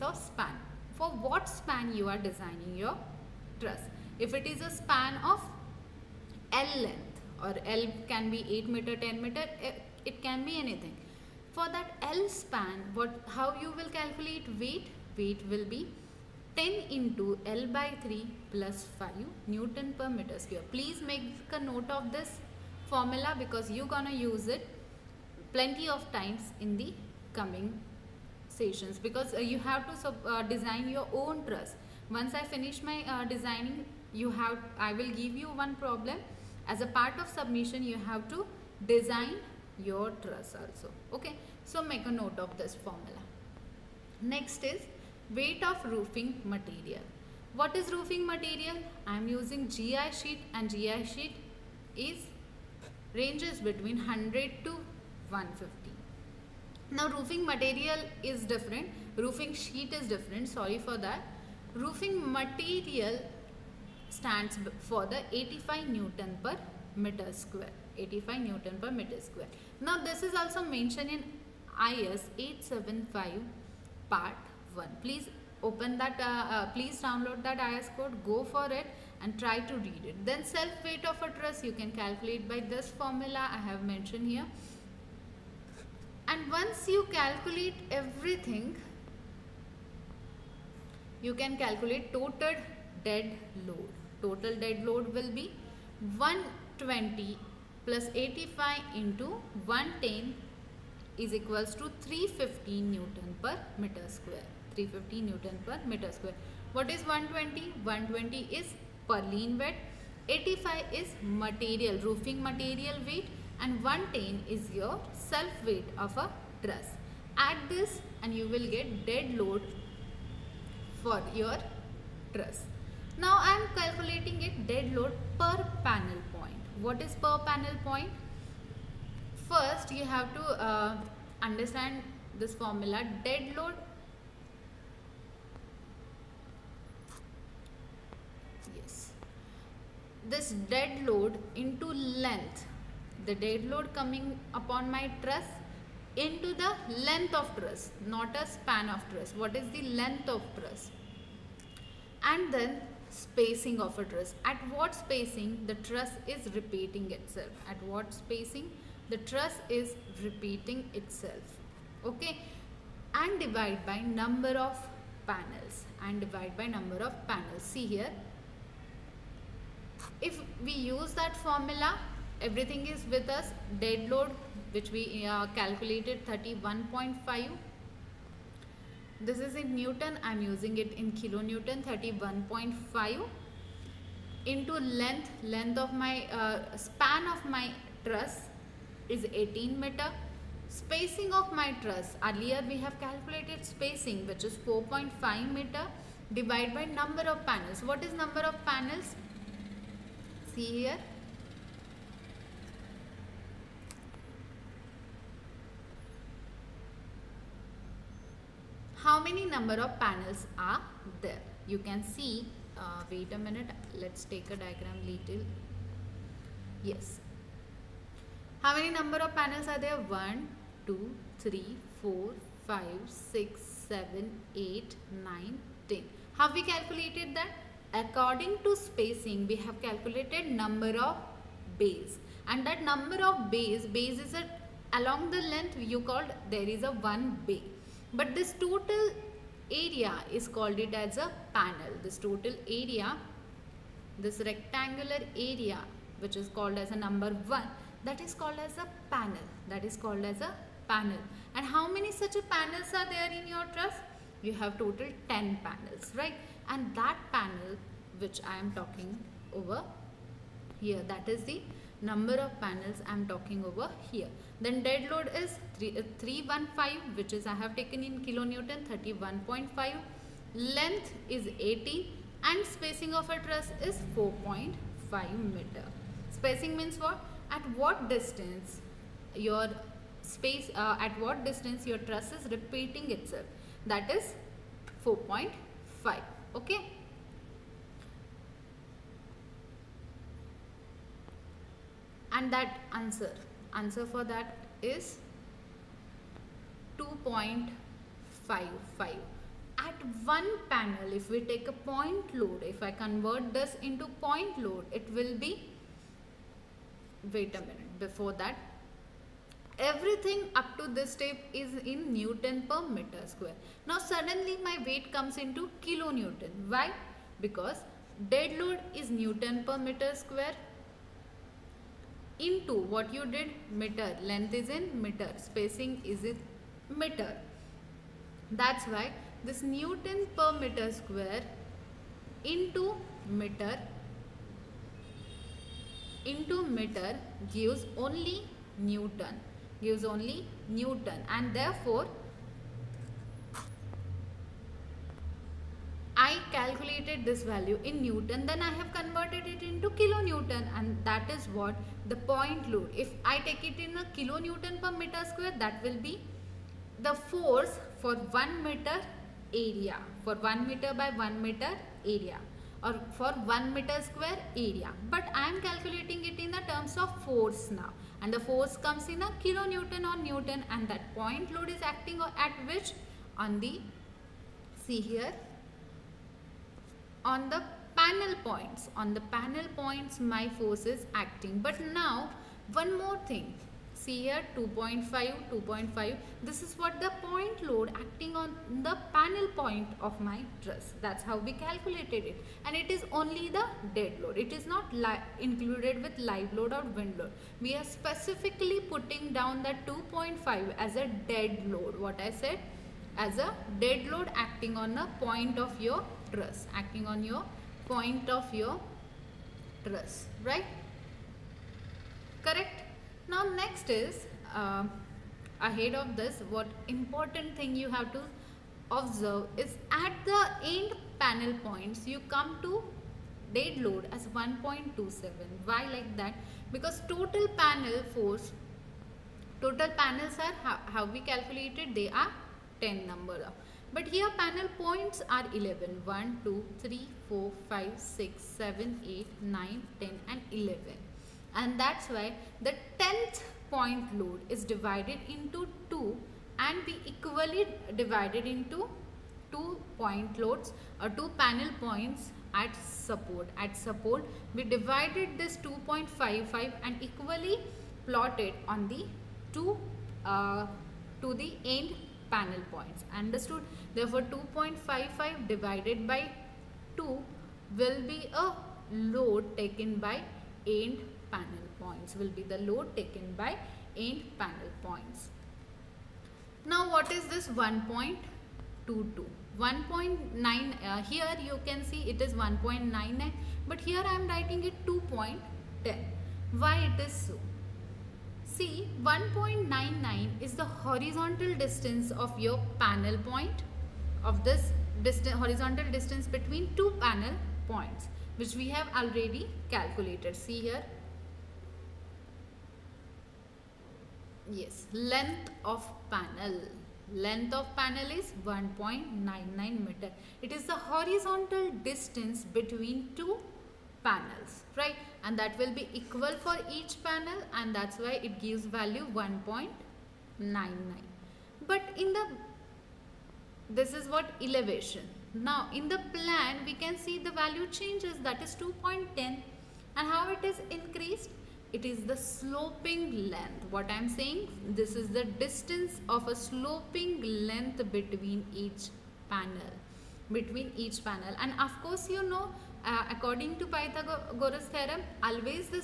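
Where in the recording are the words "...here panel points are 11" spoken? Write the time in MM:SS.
07:14.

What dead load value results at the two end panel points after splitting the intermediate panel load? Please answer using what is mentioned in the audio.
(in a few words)
1.27.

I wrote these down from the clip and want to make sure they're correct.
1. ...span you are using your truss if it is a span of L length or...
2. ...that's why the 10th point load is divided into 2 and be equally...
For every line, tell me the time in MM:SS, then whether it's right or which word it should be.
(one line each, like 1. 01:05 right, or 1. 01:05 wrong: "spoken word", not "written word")
1. 00:01 wrong: "designing", not "using"
2. 07:21 right.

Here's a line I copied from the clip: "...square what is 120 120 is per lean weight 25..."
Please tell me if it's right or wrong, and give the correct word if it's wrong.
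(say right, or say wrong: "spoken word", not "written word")
wrong: "85", not "25".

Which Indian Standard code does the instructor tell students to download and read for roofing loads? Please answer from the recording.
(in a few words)
IS 875 part 1.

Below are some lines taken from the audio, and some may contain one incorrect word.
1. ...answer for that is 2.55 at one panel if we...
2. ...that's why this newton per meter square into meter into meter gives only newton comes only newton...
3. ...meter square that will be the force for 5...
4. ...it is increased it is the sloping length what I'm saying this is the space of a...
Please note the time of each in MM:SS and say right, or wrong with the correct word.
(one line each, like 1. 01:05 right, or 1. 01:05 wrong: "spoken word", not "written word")
1. 04:53 right
2. 05:28 wrong: "gives", not "comes"
3. 05:54 wrong: "1", not "5"
4. 08:50 wrong: "distance", not "space".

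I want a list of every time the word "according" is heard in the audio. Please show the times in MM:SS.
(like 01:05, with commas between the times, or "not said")
03:48, 09:03.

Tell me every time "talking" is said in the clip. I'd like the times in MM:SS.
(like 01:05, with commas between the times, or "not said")
04:18, 04:23.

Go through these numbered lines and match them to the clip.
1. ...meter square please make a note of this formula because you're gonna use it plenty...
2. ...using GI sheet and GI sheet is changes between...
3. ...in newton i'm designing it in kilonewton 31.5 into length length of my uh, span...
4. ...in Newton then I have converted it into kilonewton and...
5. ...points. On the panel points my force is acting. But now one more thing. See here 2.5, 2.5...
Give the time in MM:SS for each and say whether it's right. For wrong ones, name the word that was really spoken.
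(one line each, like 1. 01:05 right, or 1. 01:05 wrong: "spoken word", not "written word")
1. 00:20 right
2. 00:49 wrong: "ranges", not "changes"
3. 02:59 wrong: "using", not "designing"
4. 05:47 right
5. 06:18 right.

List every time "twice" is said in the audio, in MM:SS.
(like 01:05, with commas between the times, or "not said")
not said.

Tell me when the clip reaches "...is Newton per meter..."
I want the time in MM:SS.
05:18.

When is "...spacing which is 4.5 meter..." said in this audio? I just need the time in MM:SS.
03:13.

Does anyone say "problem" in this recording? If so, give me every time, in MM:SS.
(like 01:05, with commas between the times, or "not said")
00:35.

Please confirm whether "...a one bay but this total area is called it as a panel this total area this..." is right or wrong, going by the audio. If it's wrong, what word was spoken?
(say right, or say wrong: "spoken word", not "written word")
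right.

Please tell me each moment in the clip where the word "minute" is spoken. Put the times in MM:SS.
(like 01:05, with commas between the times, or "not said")
03:33, 05:07.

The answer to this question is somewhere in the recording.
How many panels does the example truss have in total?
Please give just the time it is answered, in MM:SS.
04:15.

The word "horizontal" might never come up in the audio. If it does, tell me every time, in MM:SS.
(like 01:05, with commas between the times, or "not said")
08:10, 08:15, 08:30.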